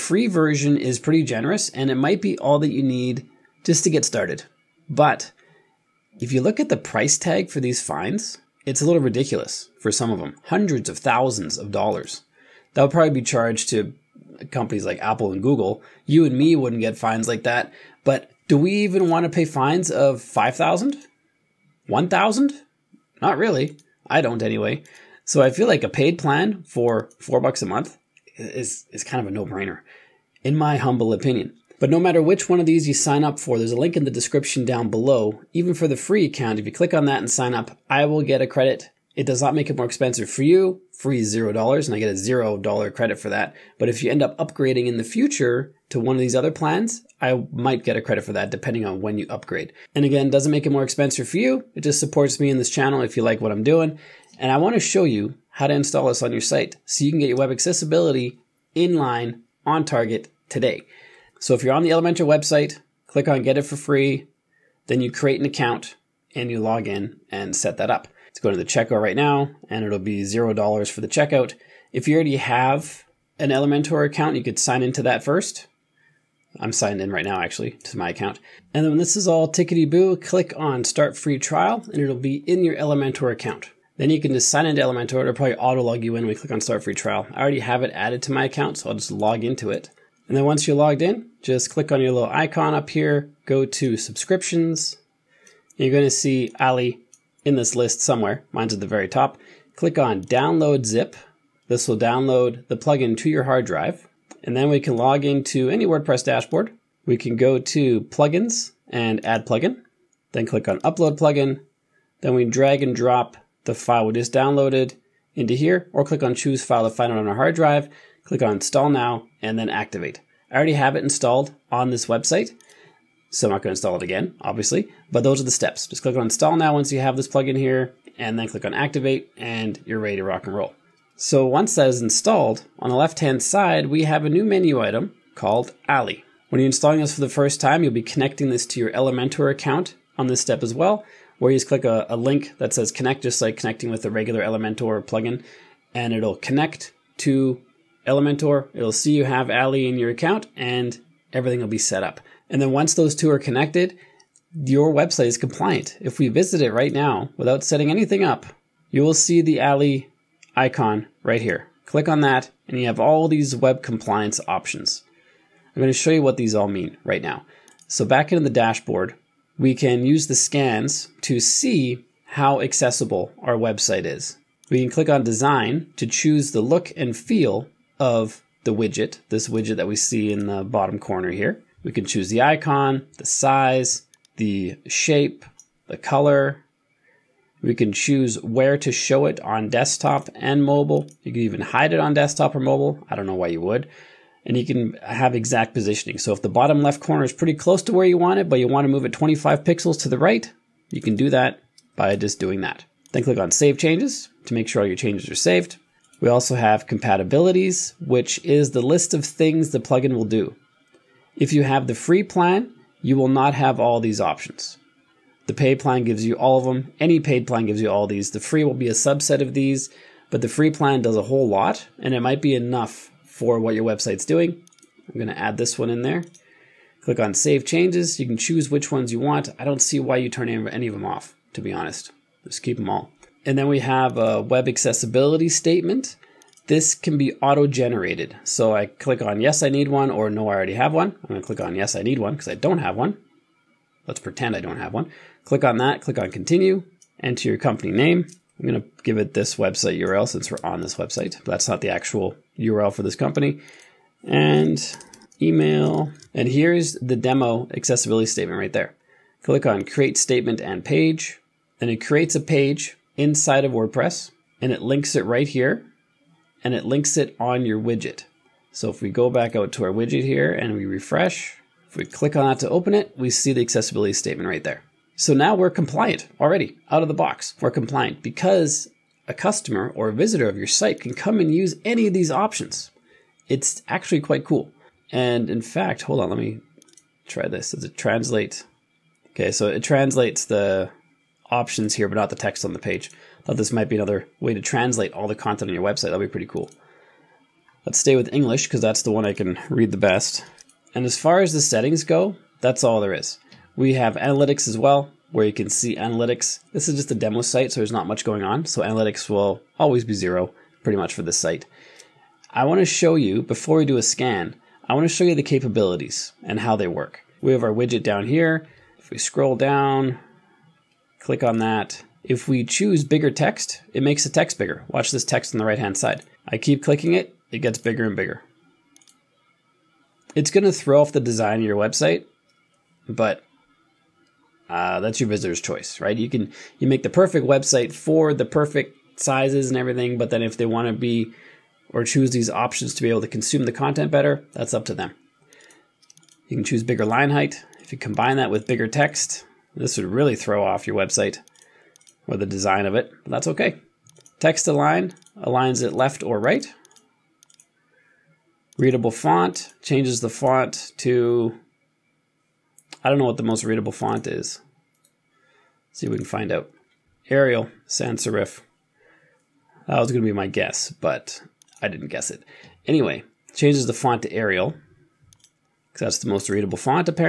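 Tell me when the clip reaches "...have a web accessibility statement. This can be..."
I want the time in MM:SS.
03:53.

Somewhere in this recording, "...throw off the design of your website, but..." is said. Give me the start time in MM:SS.
05:30.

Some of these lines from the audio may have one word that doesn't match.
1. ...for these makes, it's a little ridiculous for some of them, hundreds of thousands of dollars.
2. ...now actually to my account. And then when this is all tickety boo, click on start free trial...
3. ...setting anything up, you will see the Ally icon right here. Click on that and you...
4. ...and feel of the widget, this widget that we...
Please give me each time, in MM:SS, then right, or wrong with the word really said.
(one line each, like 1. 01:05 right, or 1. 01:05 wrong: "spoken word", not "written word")
1. 00:07 wrong: "fines", not "makes"
2. 01:17 right
3. 02:37 right
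4. 02:56 right.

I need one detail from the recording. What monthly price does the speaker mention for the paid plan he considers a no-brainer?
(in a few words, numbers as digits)
$4.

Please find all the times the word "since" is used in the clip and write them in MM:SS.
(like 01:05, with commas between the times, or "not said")
04:10.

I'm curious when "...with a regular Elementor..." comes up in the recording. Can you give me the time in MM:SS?
02:23.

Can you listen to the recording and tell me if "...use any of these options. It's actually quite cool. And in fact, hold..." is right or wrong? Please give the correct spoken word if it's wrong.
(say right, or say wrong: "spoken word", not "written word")
right.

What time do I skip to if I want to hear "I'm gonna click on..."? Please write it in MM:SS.
04:01.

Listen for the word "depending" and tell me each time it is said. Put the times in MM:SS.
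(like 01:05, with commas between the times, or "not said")
00:48.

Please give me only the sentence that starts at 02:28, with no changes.
It'll see you have Ally in your account and everything will be set up.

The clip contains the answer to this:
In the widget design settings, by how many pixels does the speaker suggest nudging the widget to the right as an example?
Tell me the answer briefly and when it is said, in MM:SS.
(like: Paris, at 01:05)
25, at 03:19.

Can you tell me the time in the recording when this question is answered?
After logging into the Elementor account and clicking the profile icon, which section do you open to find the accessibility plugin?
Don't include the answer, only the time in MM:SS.
01:33.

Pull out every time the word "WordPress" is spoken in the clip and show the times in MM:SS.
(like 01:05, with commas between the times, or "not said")
01:45, 04:23.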